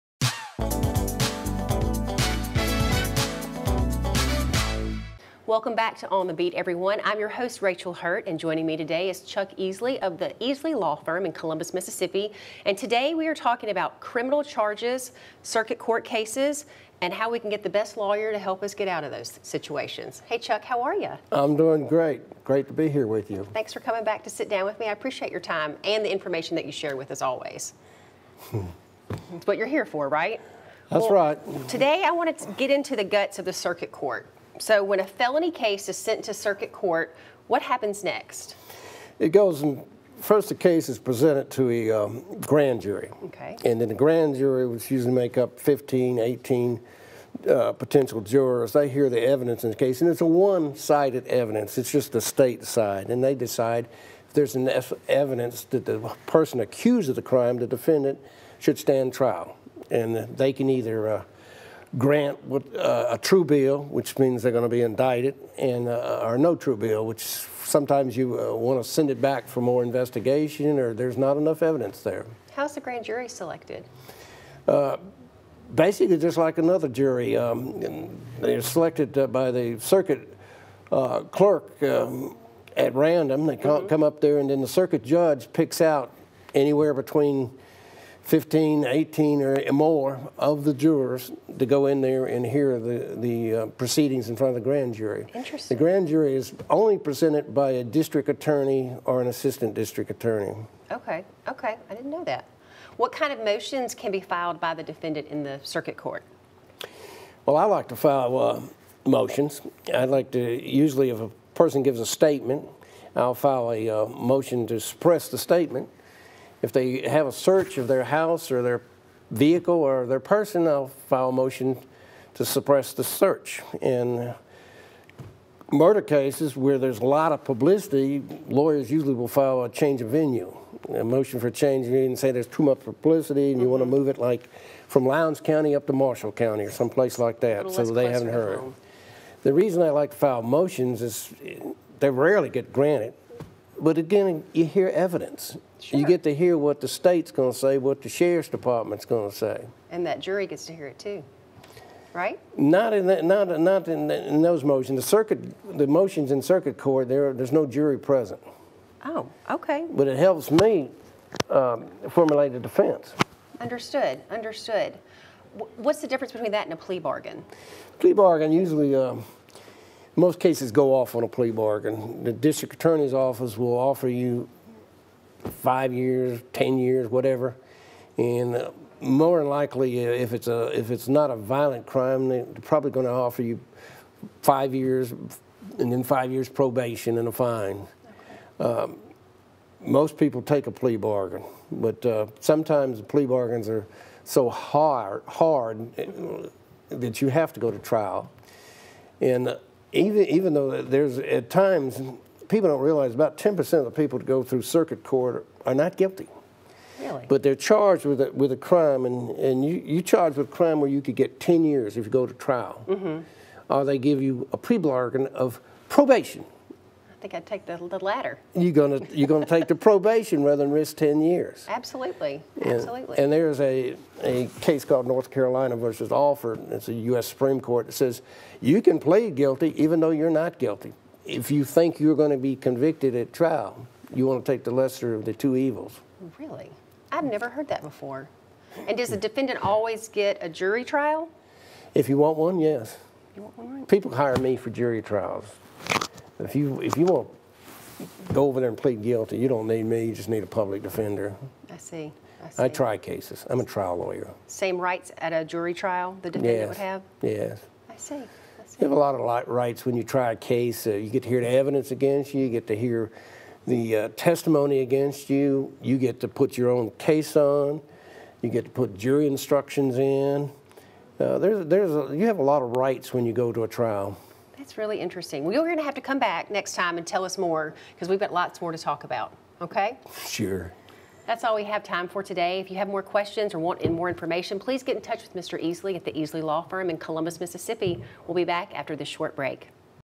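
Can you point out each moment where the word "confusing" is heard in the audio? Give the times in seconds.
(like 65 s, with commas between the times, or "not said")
not said.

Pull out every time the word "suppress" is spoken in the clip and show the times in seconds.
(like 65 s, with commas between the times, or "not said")
114 s, 122 s.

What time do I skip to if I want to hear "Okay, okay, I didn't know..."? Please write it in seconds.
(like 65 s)
100 s.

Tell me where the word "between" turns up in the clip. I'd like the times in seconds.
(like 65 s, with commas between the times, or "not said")
86 s, 166 s.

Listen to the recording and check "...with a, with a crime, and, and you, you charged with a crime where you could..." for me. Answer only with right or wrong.
right.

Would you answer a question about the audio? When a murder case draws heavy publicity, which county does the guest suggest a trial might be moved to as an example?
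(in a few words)
Marshall County.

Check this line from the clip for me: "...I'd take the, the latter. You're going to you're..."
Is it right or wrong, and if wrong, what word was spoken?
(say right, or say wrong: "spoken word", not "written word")
right.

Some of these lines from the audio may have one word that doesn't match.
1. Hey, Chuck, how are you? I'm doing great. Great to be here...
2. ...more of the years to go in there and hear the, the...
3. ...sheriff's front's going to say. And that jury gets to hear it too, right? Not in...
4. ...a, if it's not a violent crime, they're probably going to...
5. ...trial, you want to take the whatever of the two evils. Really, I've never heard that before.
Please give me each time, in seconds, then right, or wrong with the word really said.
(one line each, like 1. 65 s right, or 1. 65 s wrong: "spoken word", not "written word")
1. 20 s right
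2. 89 s wrong: "jurors", not "years"
3. 148 s wrong: "department", not "front"
4. 180 s right
5. 233 s wrong: "lesser", not "whatever".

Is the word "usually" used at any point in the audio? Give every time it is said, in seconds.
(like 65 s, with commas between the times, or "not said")
44 s, 110 s, 128 s, 168 s.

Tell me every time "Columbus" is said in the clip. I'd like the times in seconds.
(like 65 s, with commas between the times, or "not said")
11 s, 286 s.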